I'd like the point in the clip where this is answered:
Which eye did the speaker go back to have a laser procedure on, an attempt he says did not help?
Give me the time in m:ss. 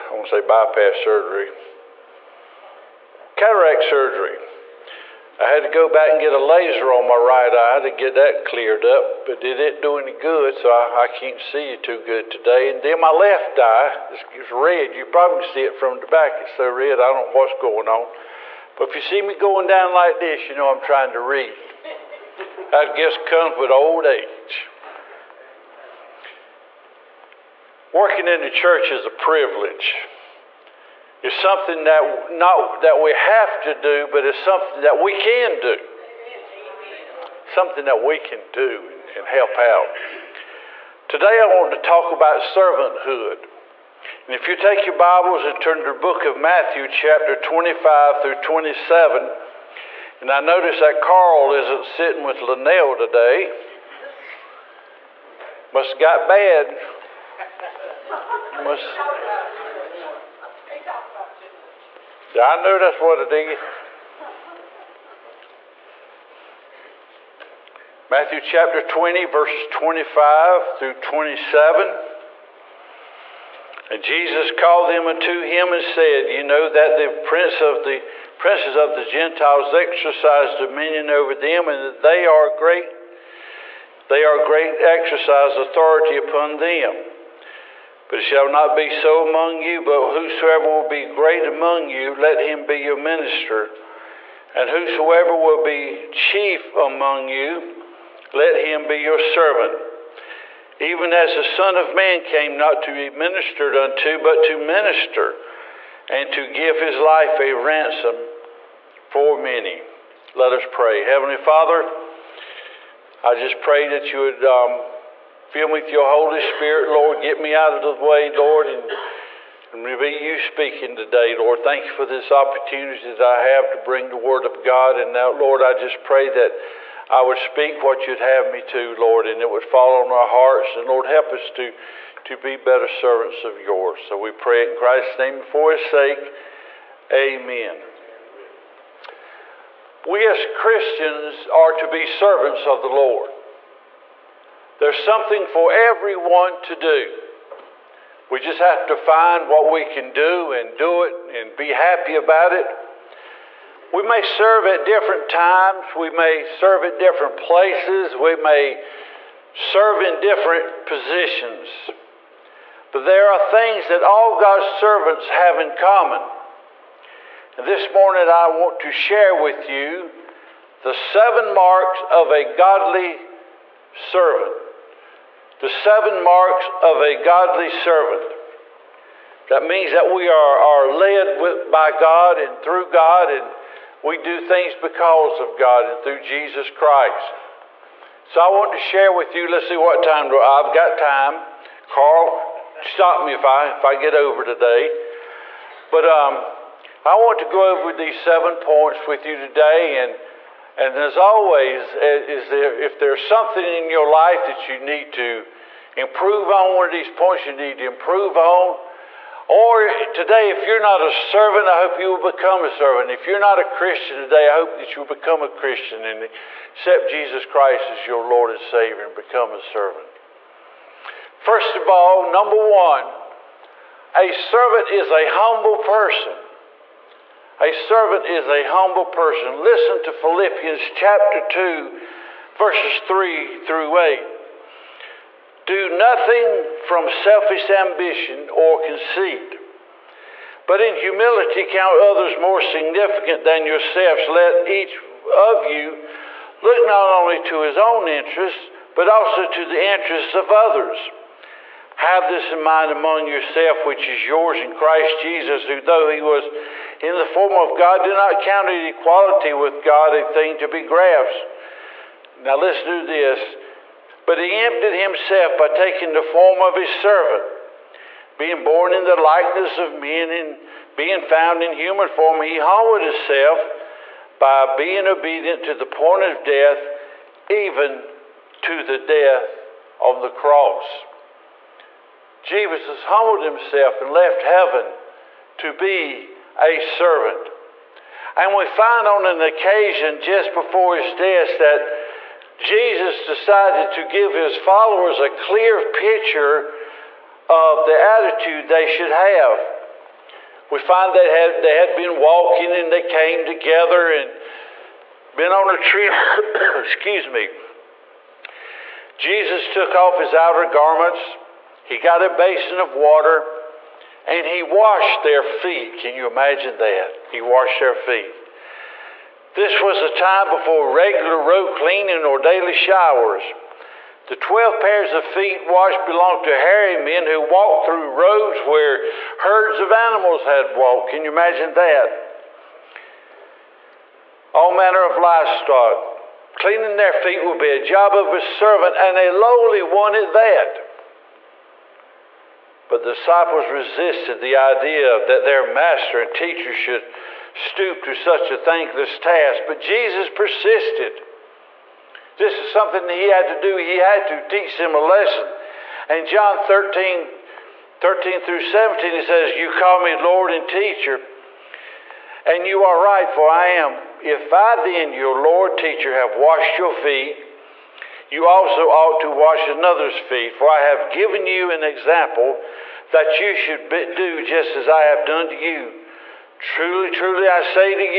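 0:07.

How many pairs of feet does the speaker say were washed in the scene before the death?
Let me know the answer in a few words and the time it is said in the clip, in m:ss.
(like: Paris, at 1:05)
12, at 5:24.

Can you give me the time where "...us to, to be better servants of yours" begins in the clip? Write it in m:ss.
2:11.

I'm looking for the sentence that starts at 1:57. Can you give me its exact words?
Get me out of the way, Lord, and, and be you speaking today, Lord.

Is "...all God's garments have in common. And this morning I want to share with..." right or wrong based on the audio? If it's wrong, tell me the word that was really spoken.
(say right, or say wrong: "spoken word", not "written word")
wrong: "servants", not "garments".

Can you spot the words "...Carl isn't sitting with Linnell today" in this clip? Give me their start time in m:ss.
0:51.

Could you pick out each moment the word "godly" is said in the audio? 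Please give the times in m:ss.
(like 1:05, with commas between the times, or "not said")
2:52, 2:57.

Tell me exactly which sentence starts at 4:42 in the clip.
Jesus humbled himself and left heaven to be a servant.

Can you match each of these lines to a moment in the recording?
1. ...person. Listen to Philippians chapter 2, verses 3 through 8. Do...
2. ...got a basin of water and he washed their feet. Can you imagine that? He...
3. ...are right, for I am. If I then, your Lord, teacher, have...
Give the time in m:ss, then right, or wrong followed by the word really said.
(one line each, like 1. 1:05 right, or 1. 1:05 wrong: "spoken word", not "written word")
1. 3:49 right
2. 5:11 right
3. 6:02 right.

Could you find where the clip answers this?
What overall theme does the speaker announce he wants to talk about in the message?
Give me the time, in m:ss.
0:42.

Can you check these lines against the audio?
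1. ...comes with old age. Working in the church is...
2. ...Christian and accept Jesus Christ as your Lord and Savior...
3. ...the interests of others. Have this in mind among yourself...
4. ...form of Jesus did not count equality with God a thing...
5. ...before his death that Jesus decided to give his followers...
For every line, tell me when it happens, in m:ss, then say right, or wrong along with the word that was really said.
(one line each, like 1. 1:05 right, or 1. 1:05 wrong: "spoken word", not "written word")
1. 0:23 right
2. 3:35 right
3. 4:09 right
4. 4:17 wrong: "God", not "Jesus"
5. 4:50 right.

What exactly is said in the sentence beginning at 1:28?
But it shall not be so among you, but whosoever will be great among you, let him be your minister.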